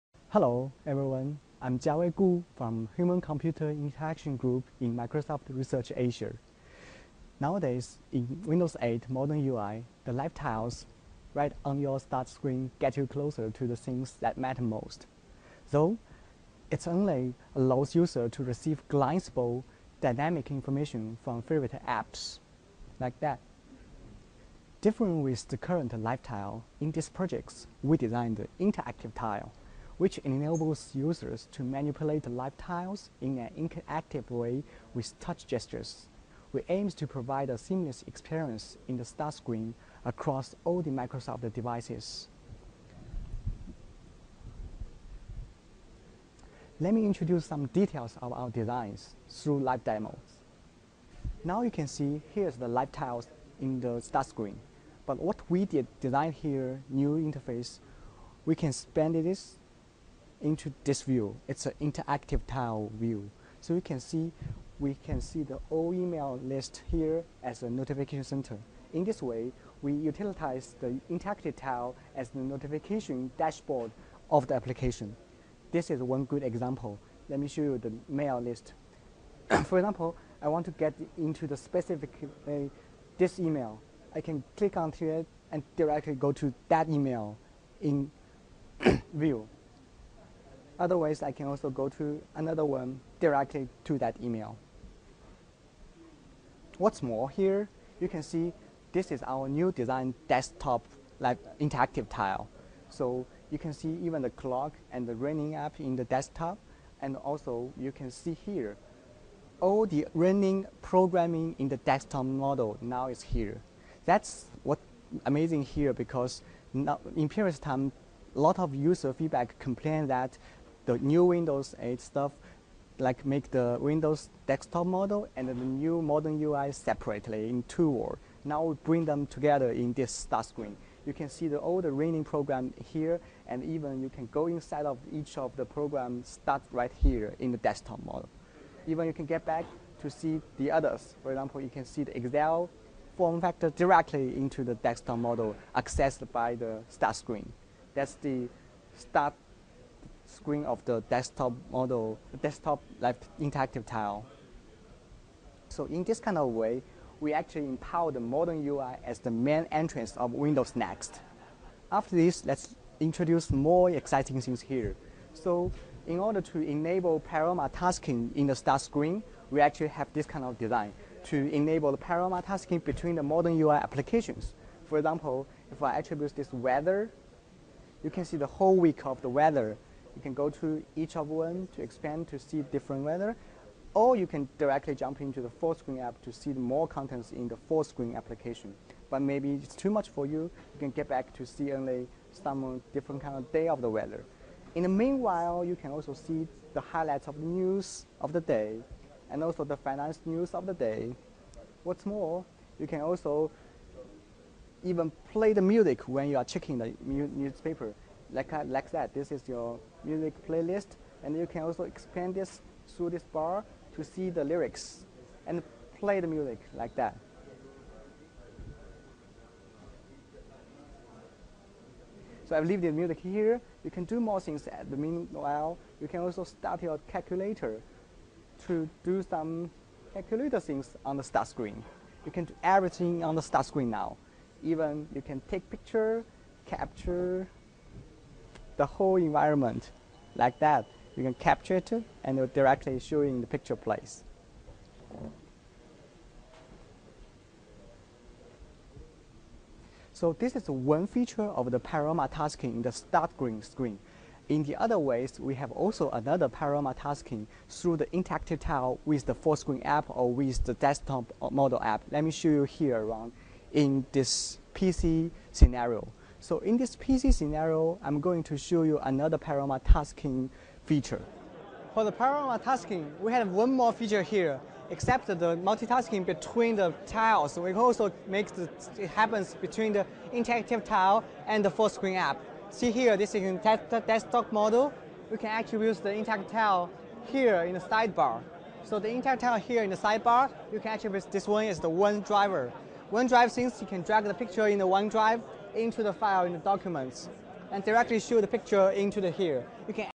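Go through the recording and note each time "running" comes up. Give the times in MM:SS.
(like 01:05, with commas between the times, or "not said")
01:45, 01:50, 02:11.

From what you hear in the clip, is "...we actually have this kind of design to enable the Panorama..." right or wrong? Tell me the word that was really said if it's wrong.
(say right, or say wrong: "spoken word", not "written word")
right.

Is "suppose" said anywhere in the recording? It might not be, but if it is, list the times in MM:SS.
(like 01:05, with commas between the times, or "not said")
not said.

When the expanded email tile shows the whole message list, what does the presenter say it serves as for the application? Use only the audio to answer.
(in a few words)
notification dashboard.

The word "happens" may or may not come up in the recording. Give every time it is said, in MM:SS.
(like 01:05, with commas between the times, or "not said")
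04:39.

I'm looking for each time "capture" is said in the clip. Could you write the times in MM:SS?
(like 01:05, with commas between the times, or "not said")
03:56, 04:01.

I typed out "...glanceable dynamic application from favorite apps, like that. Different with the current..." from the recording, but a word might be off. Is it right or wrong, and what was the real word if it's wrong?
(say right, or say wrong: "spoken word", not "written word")
wrong: "information", not "application".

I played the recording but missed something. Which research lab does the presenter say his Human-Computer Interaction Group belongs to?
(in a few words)
Microsoft Research Asia.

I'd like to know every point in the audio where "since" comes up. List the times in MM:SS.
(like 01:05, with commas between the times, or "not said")
04:53.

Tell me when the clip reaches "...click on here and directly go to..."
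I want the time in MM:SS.
01:24.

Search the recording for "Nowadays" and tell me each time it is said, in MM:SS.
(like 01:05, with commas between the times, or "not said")
00:07.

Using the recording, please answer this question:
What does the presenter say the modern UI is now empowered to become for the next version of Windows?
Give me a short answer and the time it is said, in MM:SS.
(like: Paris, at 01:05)
the main entrance, at 02:39.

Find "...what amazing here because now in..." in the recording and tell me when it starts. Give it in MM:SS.
01:54.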